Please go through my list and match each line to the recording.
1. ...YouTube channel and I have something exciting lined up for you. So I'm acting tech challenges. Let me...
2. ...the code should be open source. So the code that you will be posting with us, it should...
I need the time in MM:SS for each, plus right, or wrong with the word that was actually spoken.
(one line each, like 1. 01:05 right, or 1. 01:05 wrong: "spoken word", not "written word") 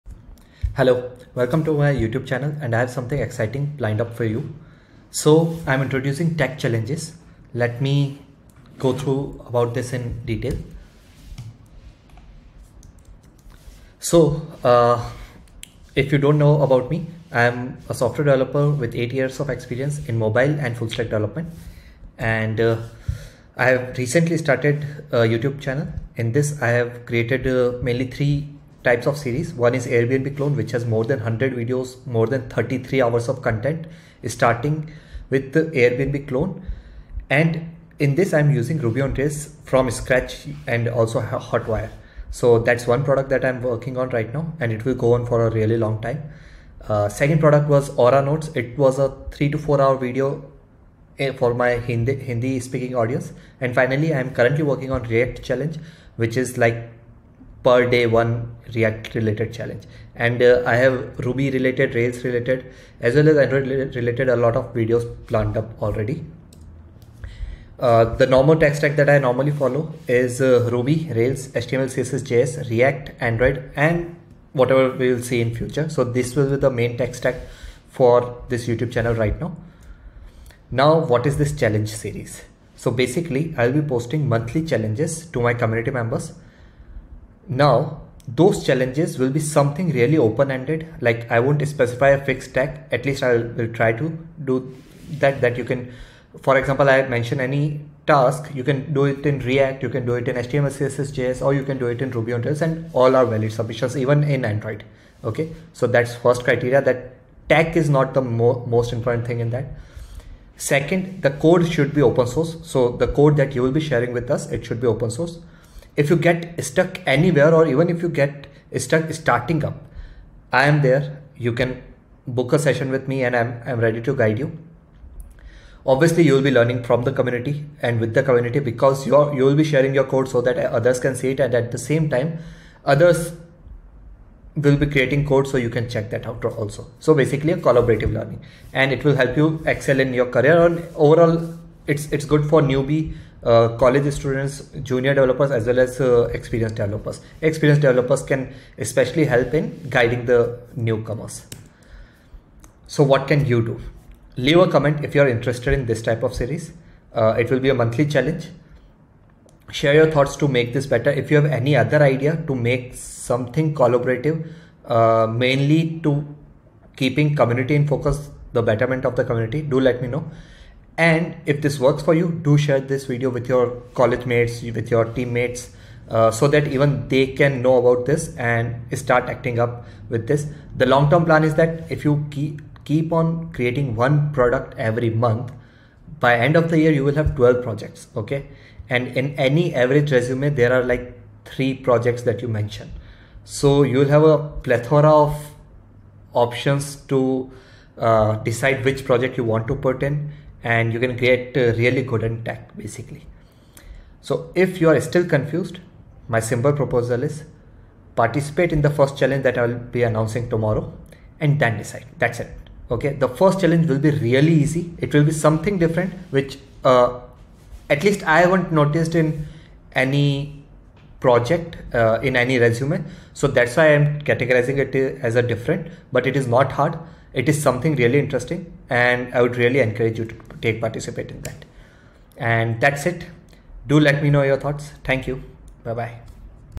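1. 00:01 wrong: "introducing", not "acting"
2. 01:51 wrong: "sharing", not "posting".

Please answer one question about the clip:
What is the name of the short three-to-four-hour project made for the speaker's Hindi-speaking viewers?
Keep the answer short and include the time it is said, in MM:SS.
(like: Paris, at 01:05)
Aura Notes, at 00:47.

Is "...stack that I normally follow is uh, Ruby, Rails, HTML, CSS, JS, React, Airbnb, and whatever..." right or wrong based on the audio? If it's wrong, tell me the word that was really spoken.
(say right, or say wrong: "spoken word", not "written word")
wrong: "Android", not "Airbnb".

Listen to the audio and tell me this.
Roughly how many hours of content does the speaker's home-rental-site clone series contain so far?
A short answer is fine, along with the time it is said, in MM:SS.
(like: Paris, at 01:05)
33, at 00:32.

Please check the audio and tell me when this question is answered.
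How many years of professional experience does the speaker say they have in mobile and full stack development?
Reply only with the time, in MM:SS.
00:18.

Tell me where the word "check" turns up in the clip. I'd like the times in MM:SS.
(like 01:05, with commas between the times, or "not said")
02:15.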